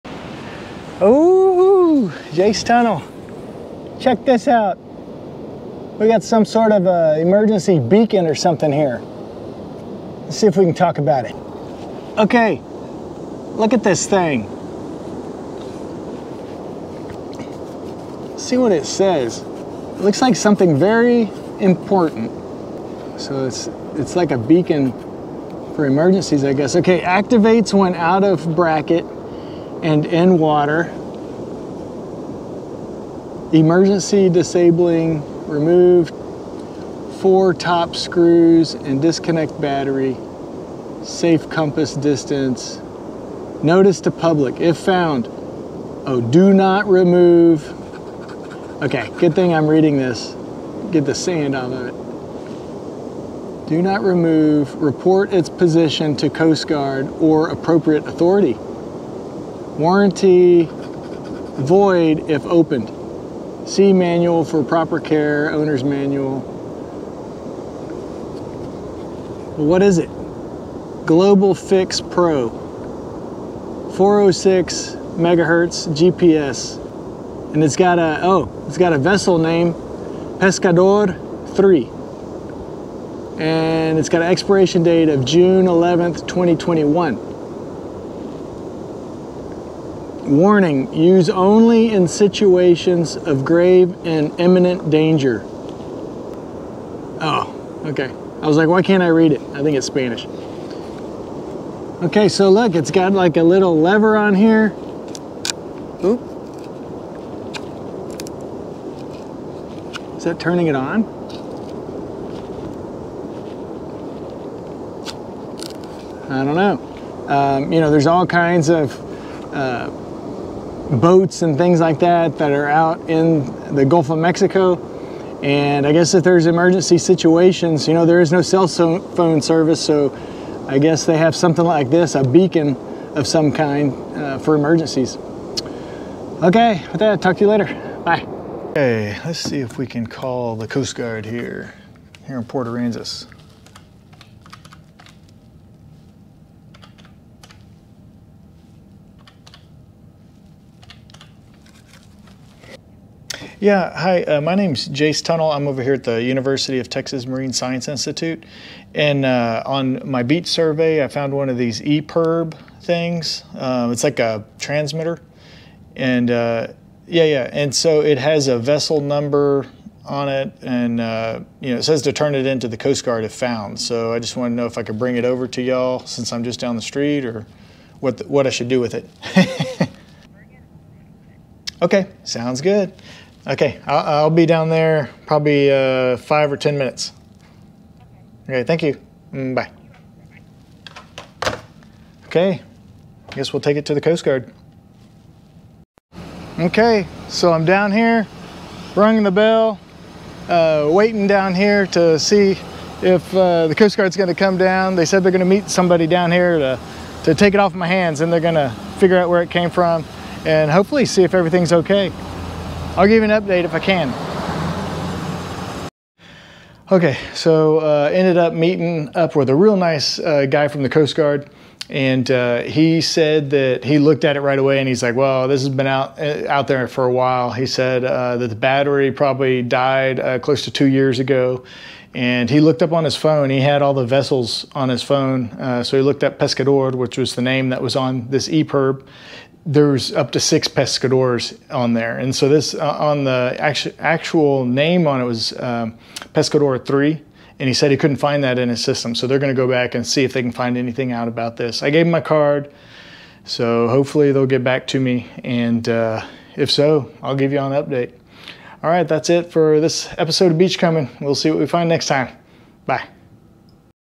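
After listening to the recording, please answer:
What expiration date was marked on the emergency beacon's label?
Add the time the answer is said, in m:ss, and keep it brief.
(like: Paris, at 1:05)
June 11, 2021, at 1:25.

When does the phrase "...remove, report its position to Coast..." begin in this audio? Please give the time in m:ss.
0:54.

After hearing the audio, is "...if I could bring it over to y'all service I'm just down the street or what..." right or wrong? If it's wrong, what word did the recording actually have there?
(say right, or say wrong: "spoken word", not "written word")
wrong: "since", not "service".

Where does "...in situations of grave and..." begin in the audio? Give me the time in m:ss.
1:31.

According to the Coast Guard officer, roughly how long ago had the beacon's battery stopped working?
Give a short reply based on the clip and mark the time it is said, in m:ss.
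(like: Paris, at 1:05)
2 years, at 3:50.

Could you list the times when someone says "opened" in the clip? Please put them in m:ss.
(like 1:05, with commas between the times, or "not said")
1:02.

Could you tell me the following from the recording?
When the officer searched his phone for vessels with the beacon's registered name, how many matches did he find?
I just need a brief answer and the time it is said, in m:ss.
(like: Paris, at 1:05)
6, at 4:00.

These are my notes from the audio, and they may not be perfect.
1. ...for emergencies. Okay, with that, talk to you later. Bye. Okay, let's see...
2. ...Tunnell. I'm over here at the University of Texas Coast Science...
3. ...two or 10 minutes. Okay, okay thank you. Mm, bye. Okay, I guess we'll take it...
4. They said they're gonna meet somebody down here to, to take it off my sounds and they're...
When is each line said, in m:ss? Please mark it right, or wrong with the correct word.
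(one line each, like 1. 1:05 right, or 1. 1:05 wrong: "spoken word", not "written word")
1. 2:14 right
2. 2:35 wrong: "Marine", not "Coast"
3. 3:06 wrong: "five", not "two"
4. 3:24 wrong: "hands", not "sounds".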